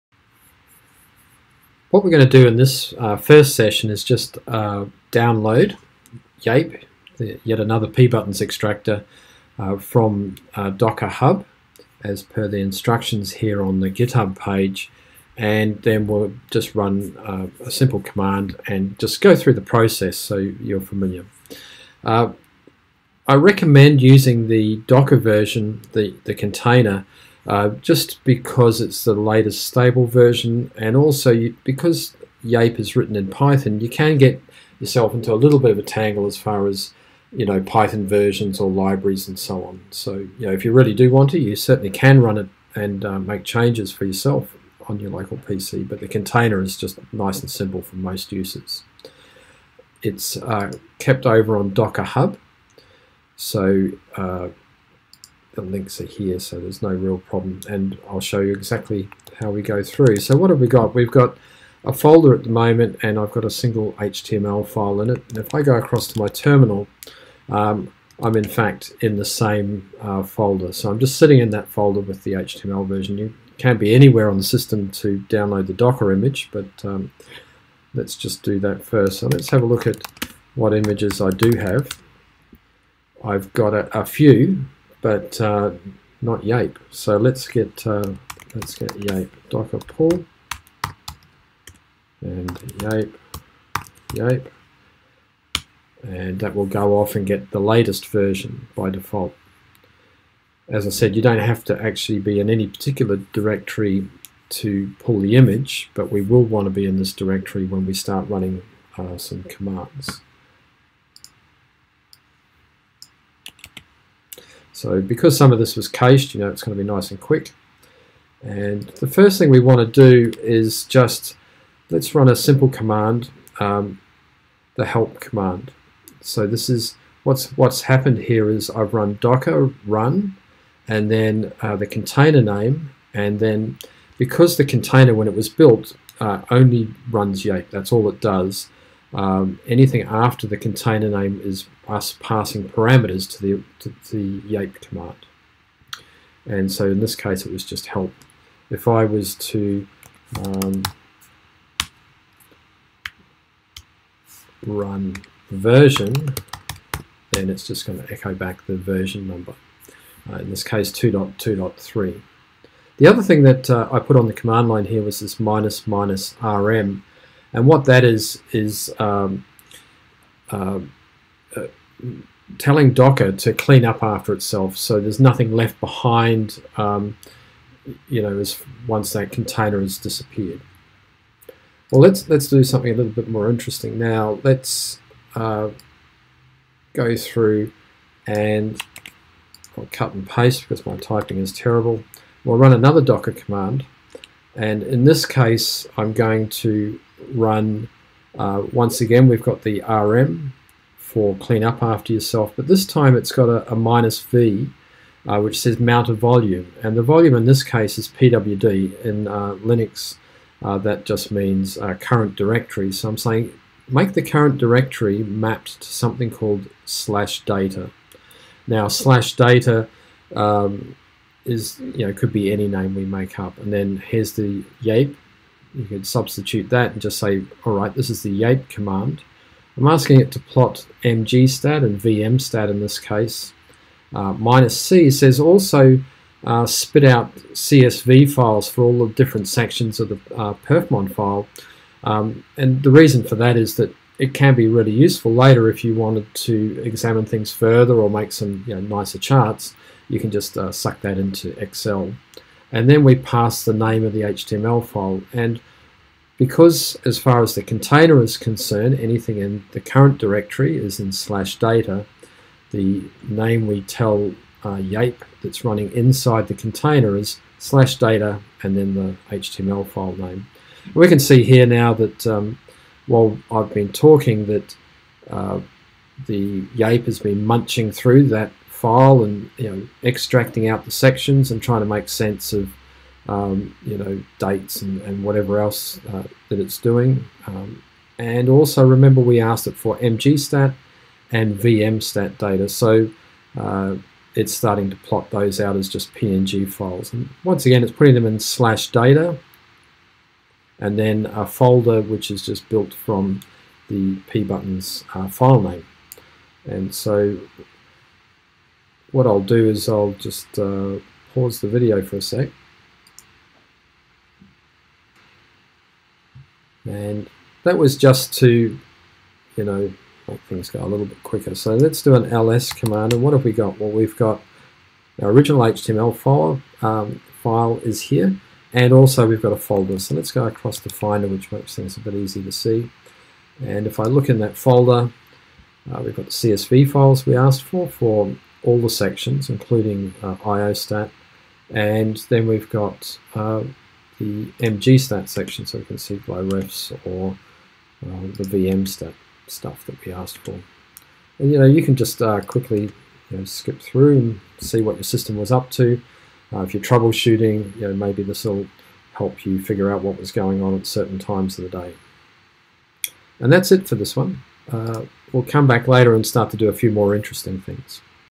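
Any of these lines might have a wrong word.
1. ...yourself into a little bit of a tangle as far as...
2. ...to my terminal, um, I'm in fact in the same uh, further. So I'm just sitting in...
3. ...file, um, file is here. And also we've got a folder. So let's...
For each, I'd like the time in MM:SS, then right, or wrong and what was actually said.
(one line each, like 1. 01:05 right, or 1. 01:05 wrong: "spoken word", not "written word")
1. 00:34 right
2. 01:06 wrong: "folder", not "further"
3. 05:26 right.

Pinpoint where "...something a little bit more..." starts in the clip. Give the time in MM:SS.
03:02.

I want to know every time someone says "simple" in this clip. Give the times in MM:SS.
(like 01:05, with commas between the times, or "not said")
00:17, 00:47, 02:02.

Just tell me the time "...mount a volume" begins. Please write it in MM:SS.
03:25.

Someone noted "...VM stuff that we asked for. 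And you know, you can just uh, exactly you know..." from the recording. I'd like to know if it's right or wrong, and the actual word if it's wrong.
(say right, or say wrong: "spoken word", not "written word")
wrong: "quickly", not "exactly".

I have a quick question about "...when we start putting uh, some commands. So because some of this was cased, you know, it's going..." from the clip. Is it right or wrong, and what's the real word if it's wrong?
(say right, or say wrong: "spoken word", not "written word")
wrong: "running", not "putting".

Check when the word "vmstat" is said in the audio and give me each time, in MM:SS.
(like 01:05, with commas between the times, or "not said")
03:51, 04:51.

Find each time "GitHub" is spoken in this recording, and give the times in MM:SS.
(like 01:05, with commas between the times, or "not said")
00:13.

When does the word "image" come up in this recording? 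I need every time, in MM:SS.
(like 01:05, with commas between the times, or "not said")
01:16, 01:20, 01:45.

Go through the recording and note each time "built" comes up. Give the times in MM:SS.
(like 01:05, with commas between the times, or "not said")
02:15, 05:02.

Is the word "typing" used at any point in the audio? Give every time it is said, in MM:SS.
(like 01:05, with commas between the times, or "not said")
03:10.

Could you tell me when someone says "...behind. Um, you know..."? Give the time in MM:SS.
02:55.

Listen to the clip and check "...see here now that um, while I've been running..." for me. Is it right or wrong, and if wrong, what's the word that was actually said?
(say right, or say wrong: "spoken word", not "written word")
wrong: "talking", not "running".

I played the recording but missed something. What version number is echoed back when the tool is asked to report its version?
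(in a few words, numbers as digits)
2.2.3.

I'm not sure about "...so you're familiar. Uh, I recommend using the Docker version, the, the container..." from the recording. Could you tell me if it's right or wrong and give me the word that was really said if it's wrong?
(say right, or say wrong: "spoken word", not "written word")
right.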